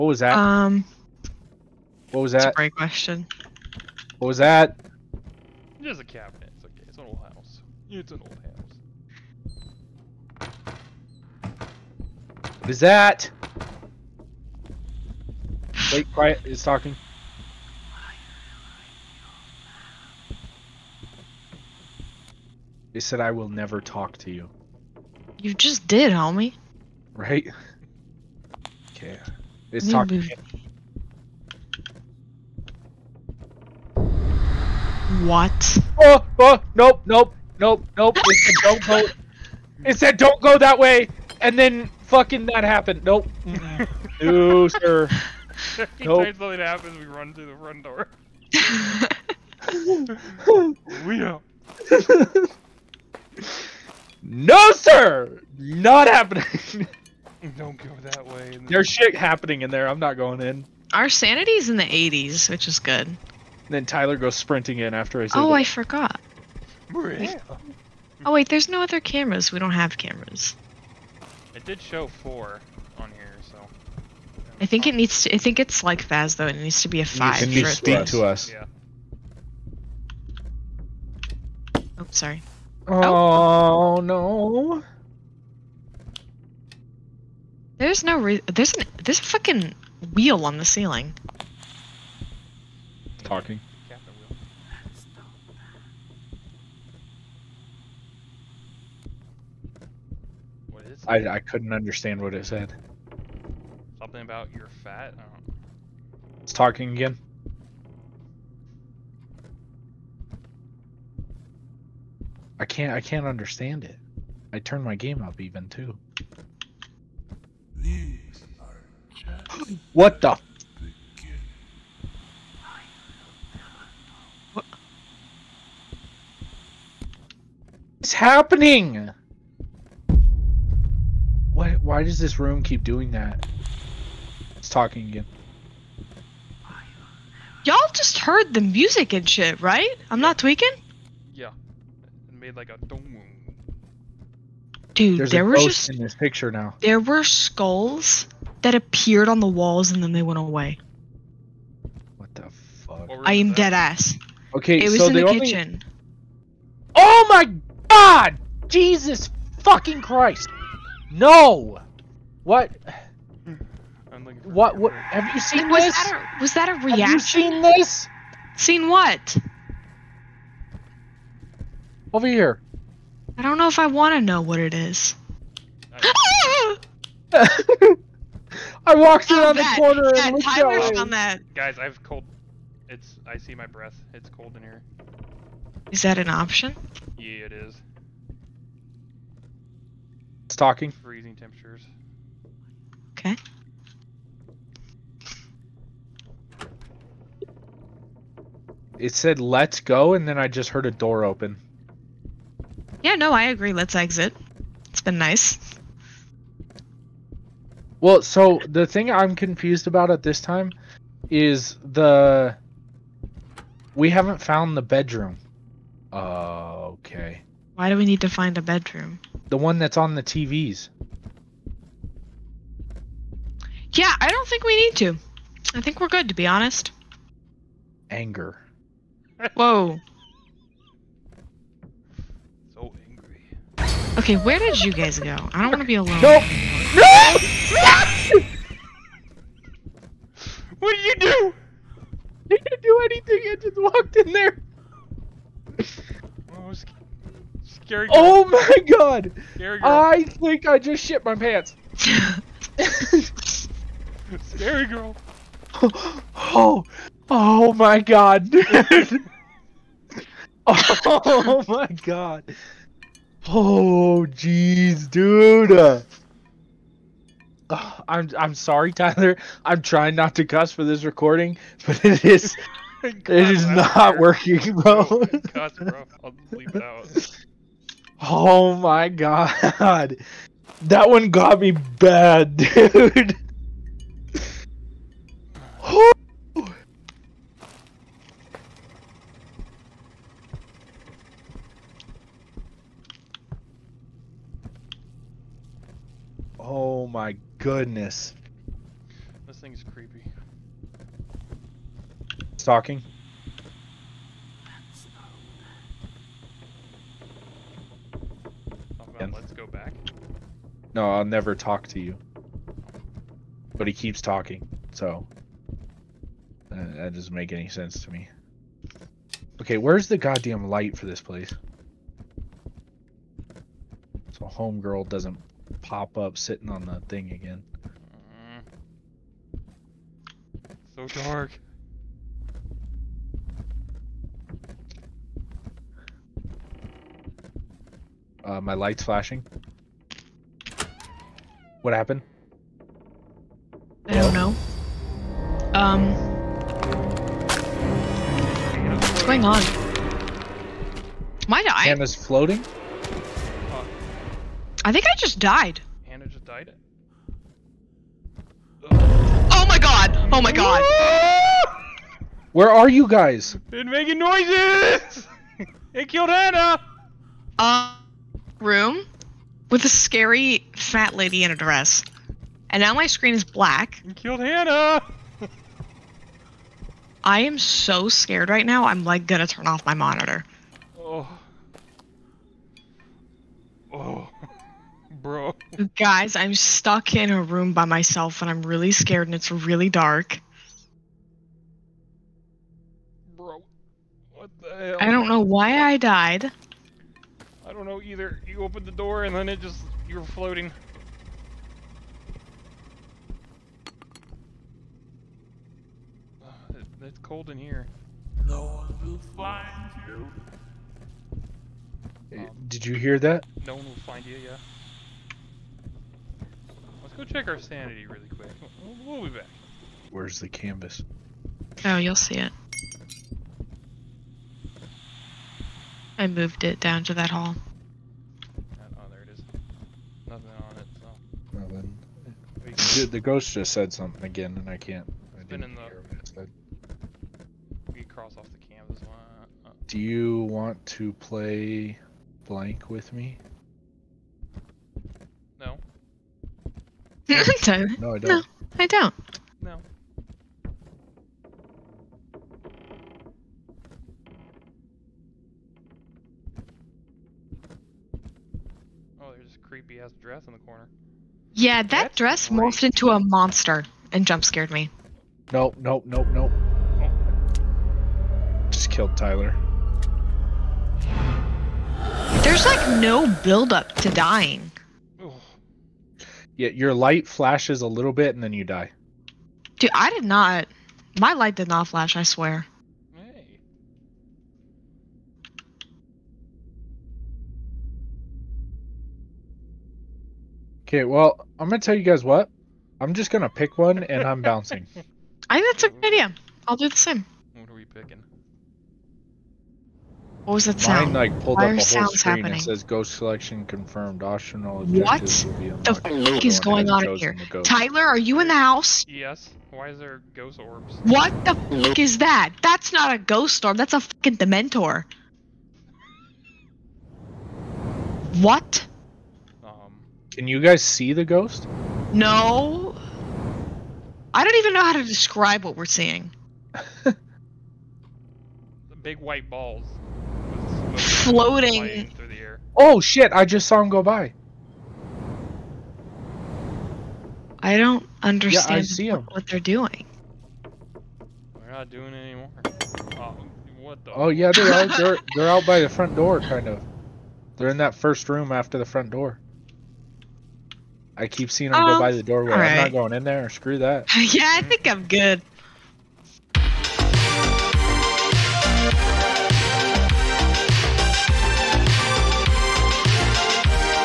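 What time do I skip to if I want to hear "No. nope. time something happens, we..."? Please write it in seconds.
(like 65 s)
45 s.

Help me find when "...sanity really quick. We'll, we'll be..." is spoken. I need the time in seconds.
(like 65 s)
417 s.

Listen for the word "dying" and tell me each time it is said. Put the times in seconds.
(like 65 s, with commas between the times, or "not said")
474 s.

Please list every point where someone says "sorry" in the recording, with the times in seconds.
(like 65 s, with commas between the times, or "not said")
82 s, 268 s.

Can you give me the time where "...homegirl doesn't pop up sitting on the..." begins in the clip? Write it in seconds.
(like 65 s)
324 s.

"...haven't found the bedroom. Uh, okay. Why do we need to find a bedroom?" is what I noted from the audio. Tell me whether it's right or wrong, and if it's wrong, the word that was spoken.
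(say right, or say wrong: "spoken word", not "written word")
right.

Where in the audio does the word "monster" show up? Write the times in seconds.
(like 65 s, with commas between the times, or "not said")
463 s.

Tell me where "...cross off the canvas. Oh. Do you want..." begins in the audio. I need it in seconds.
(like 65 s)
438 s.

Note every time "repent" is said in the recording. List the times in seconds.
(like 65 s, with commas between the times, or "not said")
not said.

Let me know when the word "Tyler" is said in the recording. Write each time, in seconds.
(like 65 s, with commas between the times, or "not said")
63 s, 180 s, 268 s, 469 s, 507 s.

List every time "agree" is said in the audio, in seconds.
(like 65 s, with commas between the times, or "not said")
203 s.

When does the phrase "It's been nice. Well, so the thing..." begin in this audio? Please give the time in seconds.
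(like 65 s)
204 s.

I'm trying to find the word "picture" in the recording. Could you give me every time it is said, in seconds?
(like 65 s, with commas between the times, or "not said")
146 s.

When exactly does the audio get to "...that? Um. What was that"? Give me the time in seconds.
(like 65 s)
0 s.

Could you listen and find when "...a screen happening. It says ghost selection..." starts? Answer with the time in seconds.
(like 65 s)
501 s.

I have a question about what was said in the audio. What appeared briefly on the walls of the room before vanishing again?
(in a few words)
skulls.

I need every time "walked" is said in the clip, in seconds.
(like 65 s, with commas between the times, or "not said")
178 s, 243 s.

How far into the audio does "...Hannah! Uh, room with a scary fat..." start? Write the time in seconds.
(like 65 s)
366 s.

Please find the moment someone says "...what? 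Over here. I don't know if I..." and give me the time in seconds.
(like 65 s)
168 s.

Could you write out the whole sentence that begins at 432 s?
Dude, the ghost just said something again, and I can't.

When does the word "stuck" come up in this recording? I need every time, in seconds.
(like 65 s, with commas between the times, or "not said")
386 s.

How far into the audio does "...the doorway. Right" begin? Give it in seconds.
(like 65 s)
552 s.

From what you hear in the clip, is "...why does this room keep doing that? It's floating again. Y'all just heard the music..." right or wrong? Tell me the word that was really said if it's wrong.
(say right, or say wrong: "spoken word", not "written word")
wrong: "talking", not "floating".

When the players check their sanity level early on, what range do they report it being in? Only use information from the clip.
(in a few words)
80s.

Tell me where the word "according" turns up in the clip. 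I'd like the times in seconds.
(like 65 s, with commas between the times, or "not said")
not said.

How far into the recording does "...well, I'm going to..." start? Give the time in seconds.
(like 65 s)
491 s.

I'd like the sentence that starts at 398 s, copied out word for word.
You opened the door and then it just, you are floating.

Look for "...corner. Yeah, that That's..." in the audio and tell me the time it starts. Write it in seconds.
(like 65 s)
460 s.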